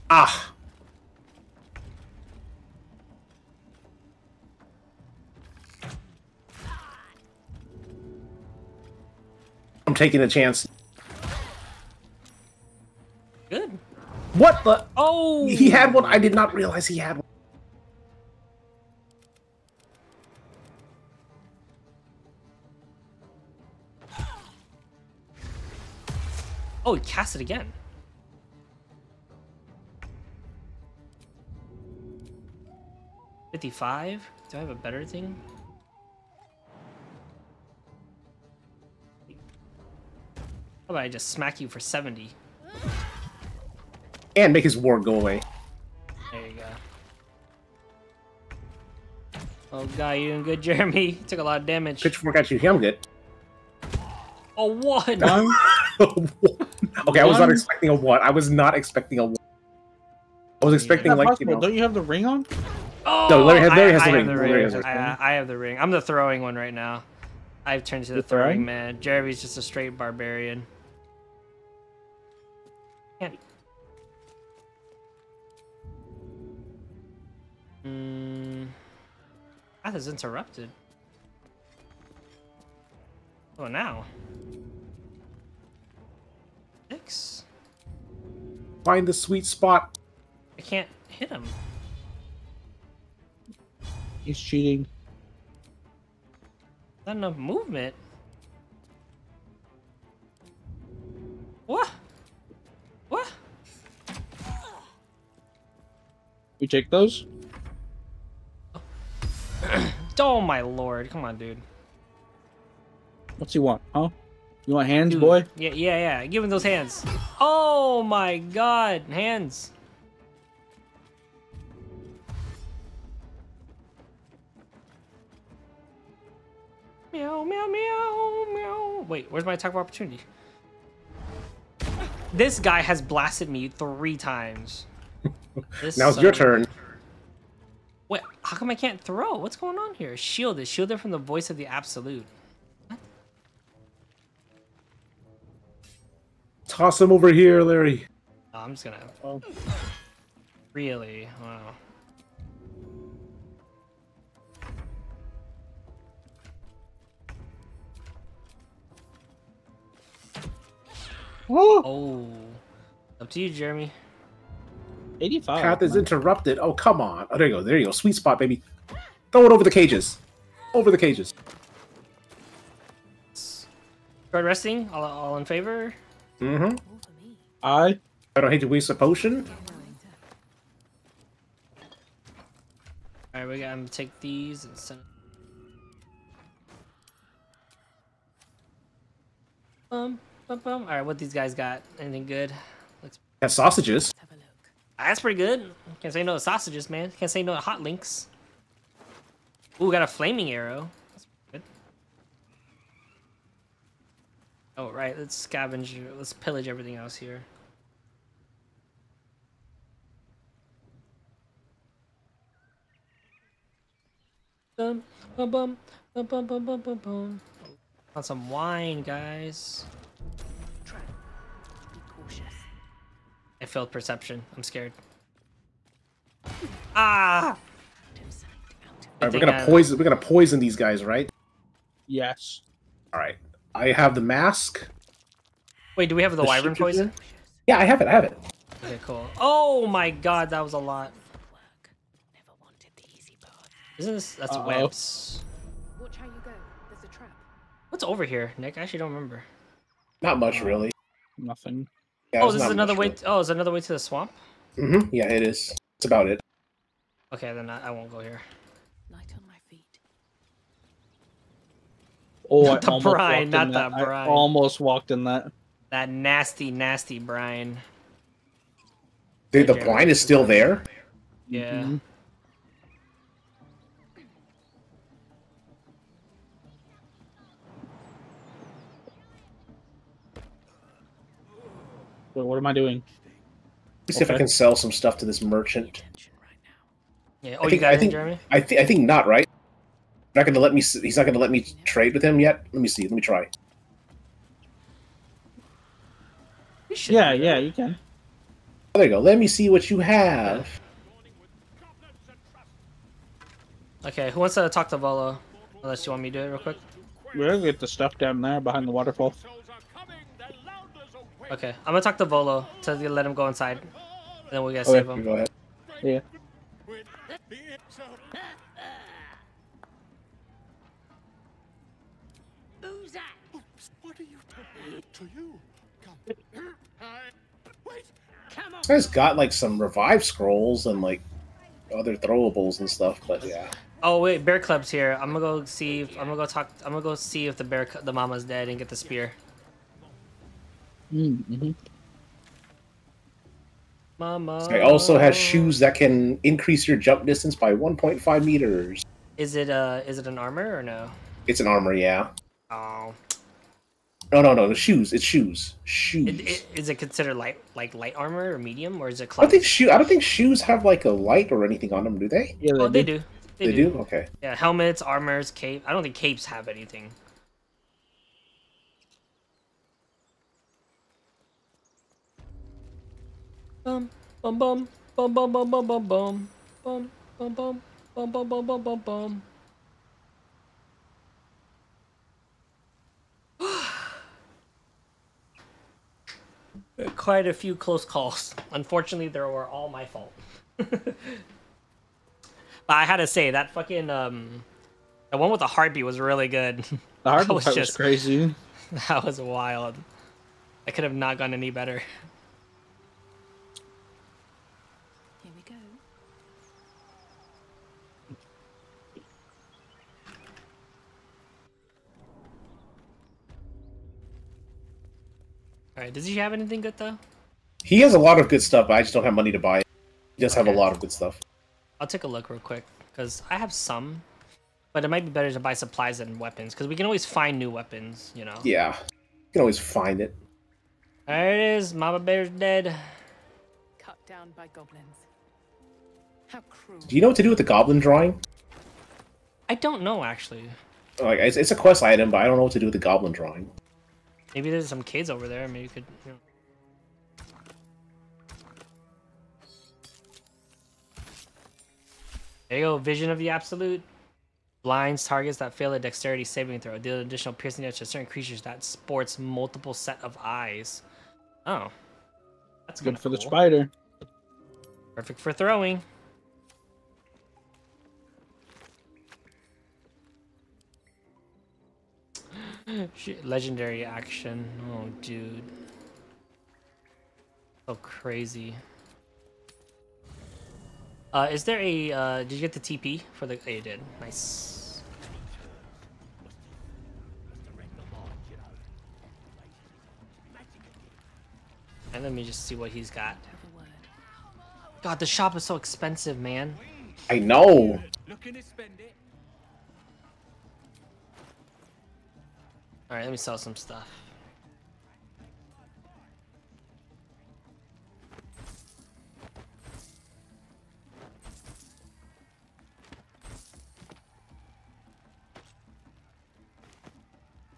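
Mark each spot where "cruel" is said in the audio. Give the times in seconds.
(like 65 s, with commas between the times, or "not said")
436 s.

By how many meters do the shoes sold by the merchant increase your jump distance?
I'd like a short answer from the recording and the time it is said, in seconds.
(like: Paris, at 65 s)
1.5, at 347 s.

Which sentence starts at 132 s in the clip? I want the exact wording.
This guy has blasted me three times.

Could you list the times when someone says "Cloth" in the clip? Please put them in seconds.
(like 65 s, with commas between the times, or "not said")
359 s.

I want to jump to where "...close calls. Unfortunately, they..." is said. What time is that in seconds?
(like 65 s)
387 s.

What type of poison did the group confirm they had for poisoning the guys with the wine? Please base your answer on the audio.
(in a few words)
Wyvern poison.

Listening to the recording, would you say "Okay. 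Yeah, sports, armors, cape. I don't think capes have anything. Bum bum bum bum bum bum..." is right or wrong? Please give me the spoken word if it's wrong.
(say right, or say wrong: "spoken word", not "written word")
wrong: "helmets", not "sports".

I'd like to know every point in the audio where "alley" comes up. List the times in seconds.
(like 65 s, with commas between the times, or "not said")
not said.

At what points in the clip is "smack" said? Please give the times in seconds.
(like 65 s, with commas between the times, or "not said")
41 s.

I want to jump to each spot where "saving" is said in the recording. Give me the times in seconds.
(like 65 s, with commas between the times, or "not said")
456 s.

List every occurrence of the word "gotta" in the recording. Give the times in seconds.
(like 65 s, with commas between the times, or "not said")
183 s, 314 s.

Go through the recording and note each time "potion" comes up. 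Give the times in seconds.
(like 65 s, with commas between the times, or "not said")
178 s.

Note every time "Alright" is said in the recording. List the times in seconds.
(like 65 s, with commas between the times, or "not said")
183 s, 415 s, 503 s.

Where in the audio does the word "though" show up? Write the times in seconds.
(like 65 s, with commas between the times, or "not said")
416 s.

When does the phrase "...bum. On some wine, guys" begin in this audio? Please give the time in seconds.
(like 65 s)
216 s.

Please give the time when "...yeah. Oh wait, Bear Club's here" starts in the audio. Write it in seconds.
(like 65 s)
333 s.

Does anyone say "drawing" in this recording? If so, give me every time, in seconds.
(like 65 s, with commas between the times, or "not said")
437 s, 443 s.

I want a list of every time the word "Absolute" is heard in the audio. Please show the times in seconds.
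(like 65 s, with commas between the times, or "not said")
141 s, 453 s.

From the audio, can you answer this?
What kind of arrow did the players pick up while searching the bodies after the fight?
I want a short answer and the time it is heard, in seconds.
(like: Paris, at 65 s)
Flaming arrow, at 200 s.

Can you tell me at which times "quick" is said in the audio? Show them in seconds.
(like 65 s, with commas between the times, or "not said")
306 s, 422 s.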